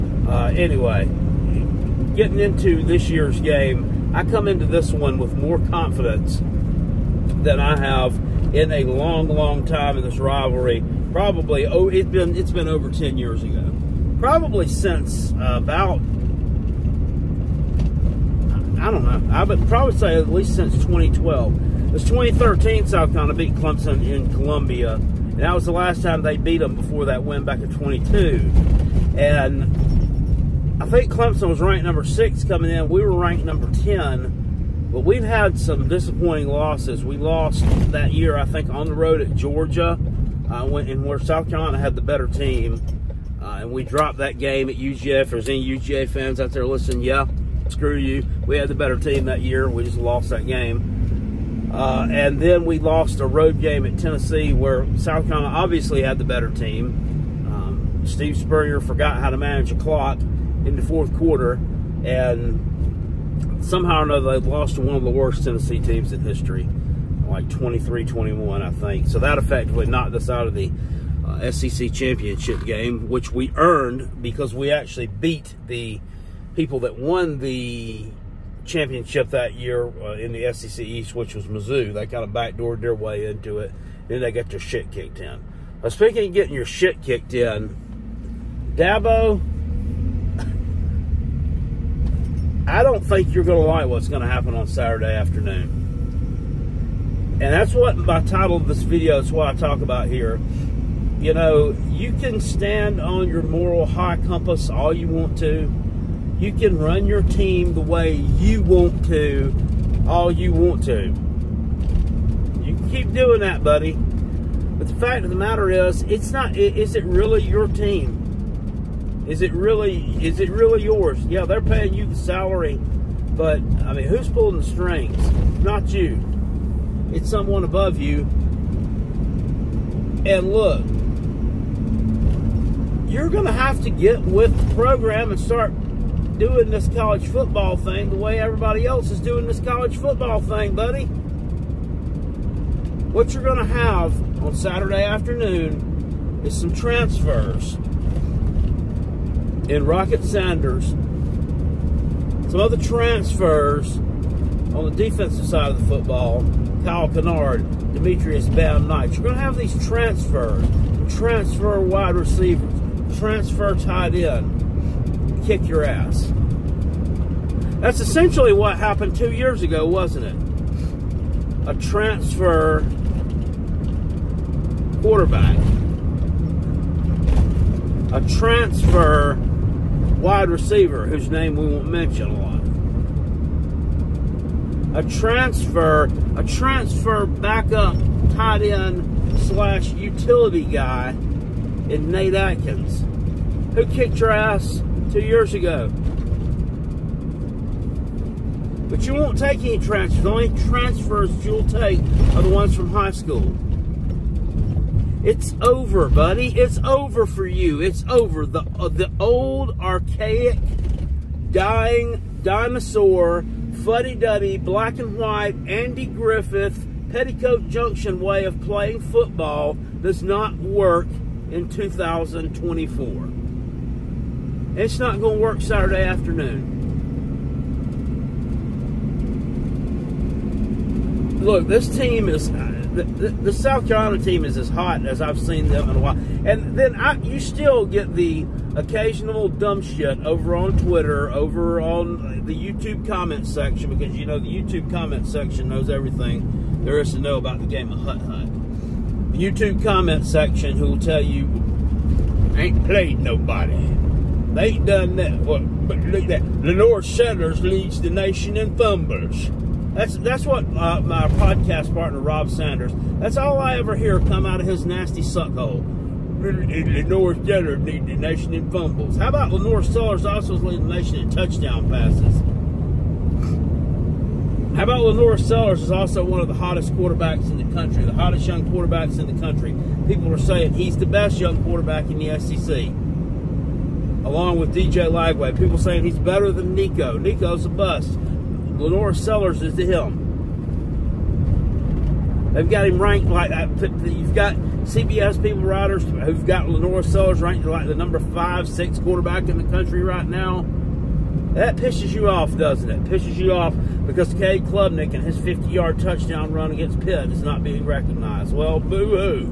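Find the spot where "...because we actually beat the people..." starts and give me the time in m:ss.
1:14.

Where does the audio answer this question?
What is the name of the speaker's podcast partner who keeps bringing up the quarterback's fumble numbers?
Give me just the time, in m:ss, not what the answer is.
4:22.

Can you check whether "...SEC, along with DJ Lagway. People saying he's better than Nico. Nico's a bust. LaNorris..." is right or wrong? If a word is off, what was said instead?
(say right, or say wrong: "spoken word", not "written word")
right.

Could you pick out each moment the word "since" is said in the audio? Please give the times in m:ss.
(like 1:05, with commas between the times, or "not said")
0:14, 0:20.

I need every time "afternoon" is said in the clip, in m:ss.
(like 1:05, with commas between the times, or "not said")
1:35, 2:25, 3:46.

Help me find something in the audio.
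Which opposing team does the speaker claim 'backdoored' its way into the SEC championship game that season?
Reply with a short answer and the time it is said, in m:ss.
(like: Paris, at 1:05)
Mizzou, at 1:21.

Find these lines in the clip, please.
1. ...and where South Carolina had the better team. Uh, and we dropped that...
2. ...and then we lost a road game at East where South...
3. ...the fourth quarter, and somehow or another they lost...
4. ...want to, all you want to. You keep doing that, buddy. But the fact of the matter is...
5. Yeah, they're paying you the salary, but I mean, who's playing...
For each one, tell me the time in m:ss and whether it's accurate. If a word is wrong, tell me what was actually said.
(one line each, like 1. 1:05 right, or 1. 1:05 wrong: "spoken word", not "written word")
1. 0:40 right
2. 0:52 wrong: "Tennessee", not "East"
3. 1:00 right
4. 1:48 right
5. 2:01 wrong: "pulling", not "playing".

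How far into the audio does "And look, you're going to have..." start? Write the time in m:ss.
2:10.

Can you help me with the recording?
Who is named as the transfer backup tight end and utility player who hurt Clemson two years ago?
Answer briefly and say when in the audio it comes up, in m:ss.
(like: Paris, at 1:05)
Nate Atkins, at 3:12.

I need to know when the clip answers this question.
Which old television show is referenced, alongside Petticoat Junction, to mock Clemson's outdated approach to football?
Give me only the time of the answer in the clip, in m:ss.
3:35.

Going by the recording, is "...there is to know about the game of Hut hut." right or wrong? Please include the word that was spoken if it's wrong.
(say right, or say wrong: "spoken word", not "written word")
right.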